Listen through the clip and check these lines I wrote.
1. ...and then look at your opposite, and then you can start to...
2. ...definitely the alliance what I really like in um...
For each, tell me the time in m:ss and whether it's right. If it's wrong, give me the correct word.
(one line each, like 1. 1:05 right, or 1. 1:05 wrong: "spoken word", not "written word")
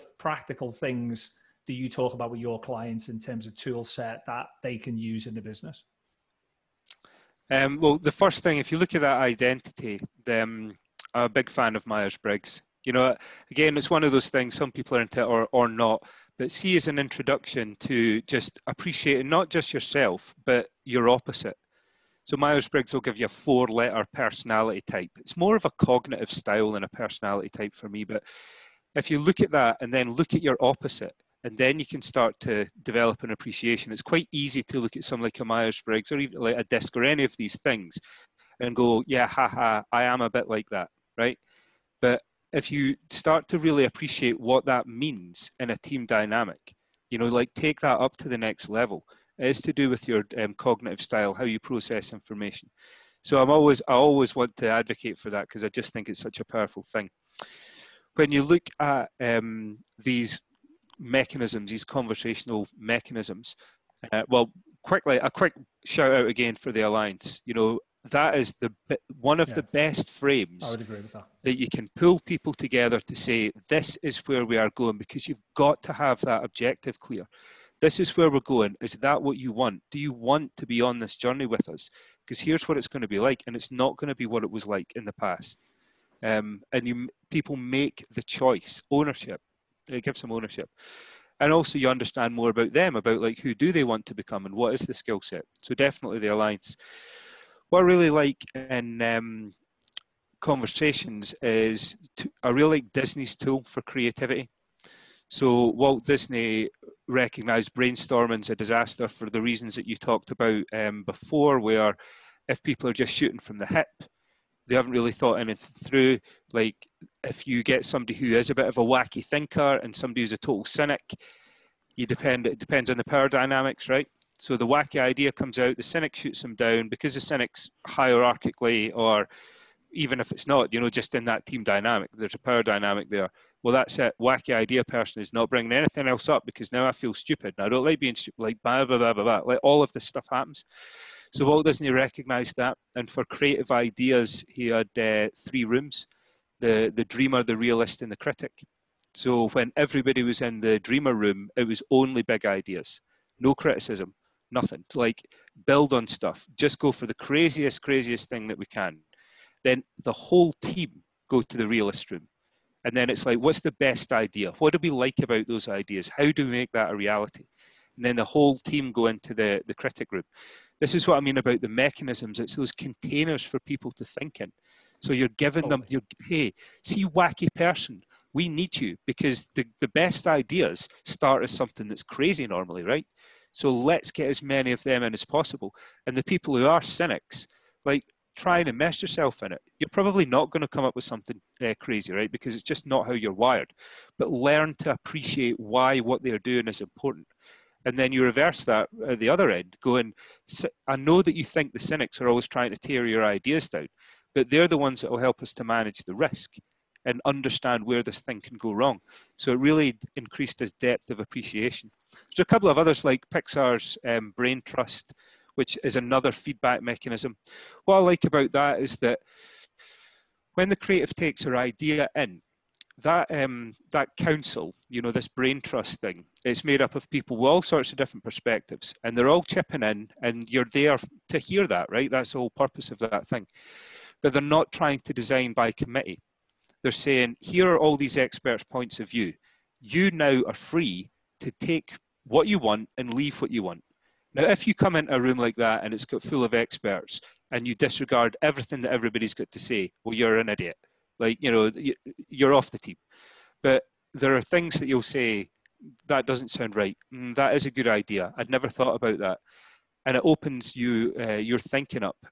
1. 0:29 right
2. 1:35 right.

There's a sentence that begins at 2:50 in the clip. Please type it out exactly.
This is what I mean about the mechanisms.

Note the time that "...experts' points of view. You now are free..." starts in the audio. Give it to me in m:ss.
3:58.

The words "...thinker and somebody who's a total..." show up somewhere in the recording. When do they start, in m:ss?
1:59.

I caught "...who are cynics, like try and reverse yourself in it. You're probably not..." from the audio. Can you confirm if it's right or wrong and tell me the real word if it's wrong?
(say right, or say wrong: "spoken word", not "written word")
wrong: "immerse", not "reverse".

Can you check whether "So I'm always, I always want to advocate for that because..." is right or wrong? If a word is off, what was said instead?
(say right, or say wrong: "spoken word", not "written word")
right.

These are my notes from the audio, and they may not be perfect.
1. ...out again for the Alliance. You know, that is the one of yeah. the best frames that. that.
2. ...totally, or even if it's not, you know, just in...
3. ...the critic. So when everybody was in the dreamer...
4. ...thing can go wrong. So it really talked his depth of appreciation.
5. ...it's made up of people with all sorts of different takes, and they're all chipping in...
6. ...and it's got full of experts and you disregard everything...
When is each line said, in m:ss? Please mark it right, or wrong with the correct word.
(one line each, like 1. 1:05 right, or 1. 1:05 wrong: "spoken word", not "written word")
1. 1:06 right
2. 2:07 wrong: "hierarchically", not "totally"
3. 2:28 right
4. 3:28 wrong: "increased", not "talked"
5. 3:46 wrong: "perspectives", not "takes"
6. 4:05 right.